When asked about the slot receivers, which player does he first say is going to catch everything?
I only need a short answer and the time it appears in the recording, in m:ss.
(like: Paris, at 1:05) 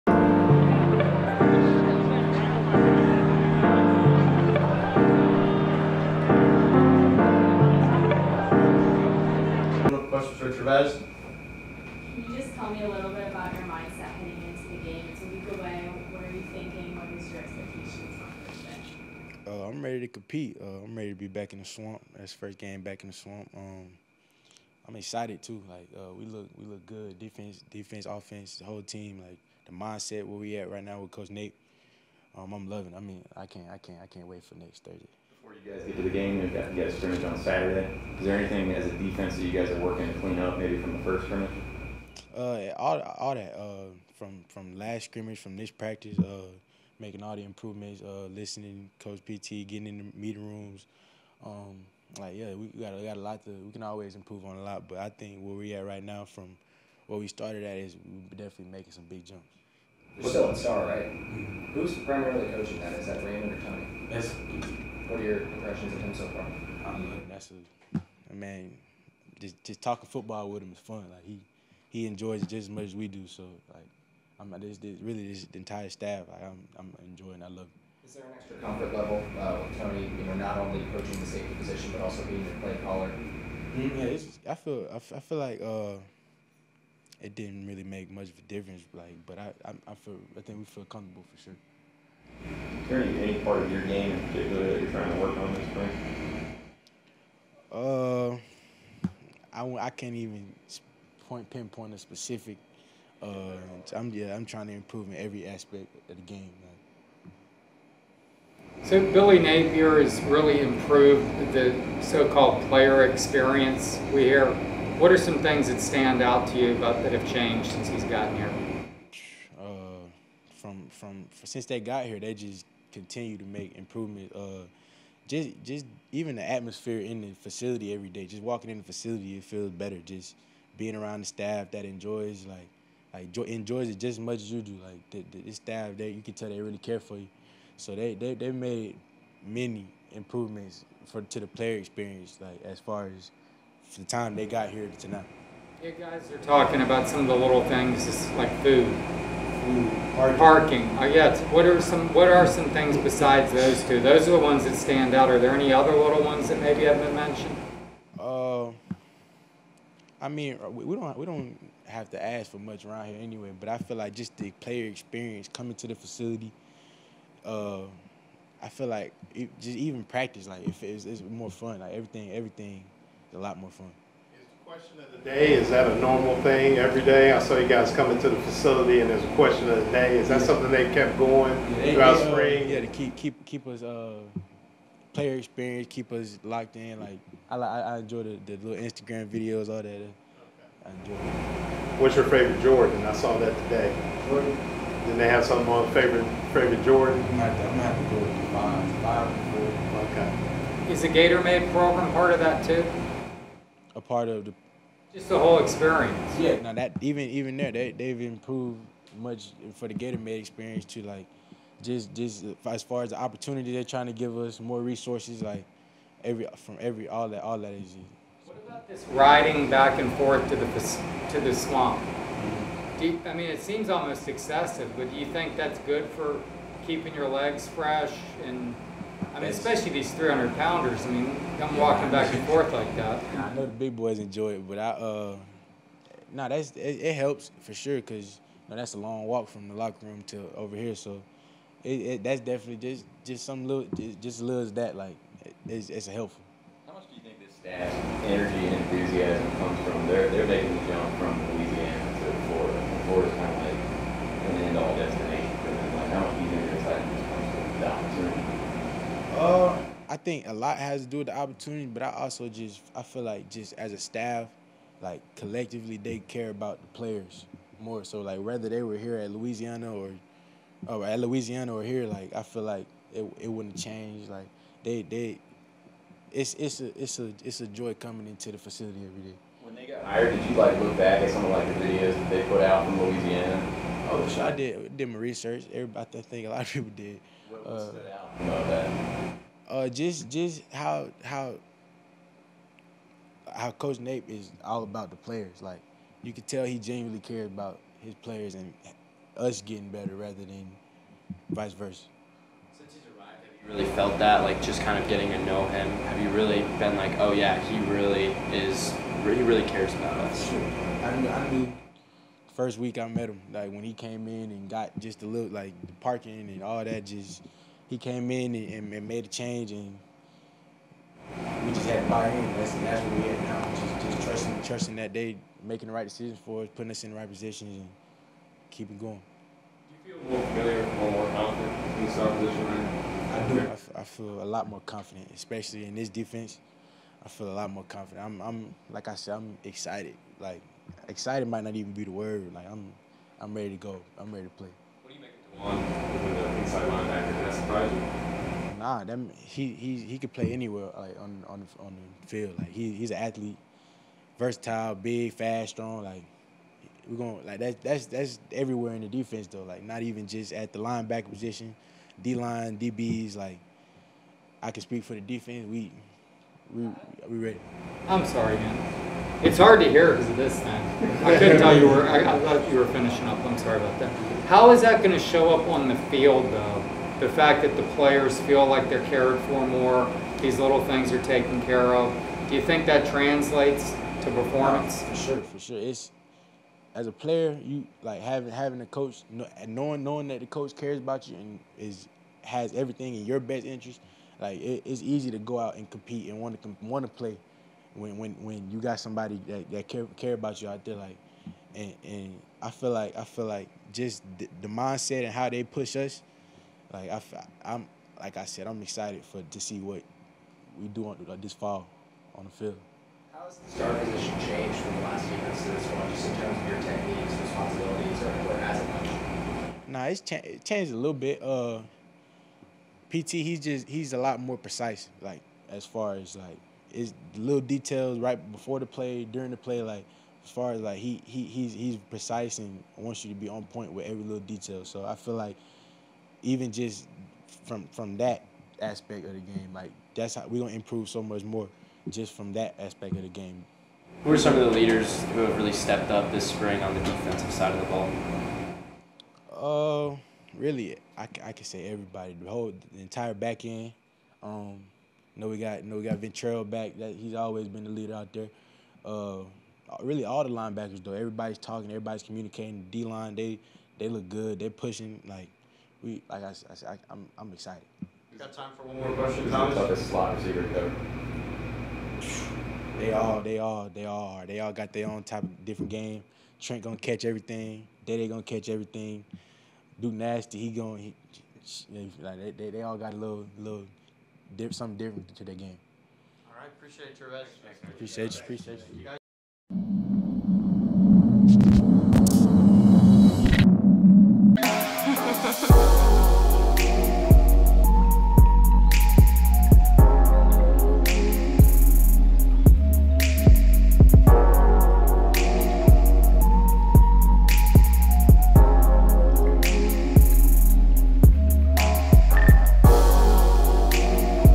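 Trent, at 7:56.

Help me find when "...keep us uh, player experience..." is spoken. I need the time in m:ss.
3:03.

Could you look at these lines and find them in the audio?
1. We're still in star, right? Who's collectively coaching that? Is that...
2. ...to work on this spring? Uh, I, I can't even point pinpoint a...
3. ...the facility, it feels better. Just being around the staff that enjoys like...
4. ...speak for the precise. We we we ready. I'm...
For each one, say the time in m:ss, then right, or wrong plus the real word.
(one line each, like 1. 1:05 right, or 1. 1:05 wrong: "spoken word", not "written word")
1. 1:00 wrong: "primarily", not "collectively"
2. 1:35 right
3. 2:08 right
4. 6:04 wrong: "defense", not "precise".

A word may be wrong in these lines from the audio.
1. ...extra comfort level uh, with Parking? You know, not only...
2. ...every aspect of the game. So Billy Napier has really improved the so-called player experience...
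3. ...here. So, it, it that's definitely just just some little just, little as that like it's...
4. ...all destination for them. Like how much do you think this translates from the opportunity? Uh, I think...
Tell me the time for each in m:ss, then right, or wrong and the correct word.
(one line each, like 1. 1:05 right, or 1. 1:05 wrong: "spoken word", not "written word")
1. 1:18 wrong: "Toney", not "Parking"
2. 1:45 right
3. 4:00 right
4. 4:14 wrong: "comes", not "translates".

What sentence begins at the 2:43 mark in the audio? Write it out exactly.
But I feel like just the player experience coming to the facility.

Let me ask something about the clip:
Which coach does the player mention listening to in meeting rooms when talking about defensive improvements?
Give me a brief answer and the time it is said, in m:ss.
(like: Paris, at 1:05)
Coach PT, at 0:48.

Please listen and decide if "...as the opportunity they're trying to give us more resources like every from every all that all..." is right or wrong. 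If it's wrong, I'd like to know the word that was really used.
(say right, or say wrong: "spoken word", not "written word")
right.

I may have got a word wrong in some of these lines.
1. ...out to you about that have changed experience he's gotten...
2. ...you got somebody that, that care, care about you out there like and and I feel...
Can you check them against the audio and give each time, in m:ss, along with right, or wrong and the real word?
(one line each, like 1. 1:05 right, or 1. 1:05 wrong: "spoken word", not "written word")
1. 1:56 wrong: "since", not "experience"
2. 6:38 right.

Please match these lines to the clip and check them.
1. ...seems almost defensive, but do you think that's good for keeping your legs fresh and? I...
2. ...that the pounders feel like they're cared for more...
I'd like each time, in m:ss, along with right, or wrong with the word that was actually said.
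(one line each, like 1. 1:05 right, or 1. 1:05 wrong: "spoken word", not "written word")
1. 3:43 wrong: "excessive", not "defensive"
2. 6:17 wrong: "players", not "pounders".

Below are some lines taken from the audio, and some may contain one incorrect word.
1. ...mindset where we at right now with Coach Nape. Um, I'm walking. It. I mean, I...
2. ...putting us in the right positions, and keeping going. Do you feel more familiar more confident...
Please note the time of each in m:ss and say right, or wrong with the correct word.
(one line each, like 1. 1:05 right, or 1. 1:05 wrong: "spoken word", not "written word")
1. 0:29 wrong: "loving", not "walking"
2. 5:26 right.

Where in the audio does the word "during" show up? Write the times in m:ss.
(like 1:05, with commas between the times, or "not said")
7:09.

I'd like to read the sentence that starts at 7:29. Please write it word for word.
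Uh, really, I, I can say everybody, the whole the entire back end.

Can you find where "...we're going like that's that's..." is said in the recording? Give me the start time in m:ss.
5:57.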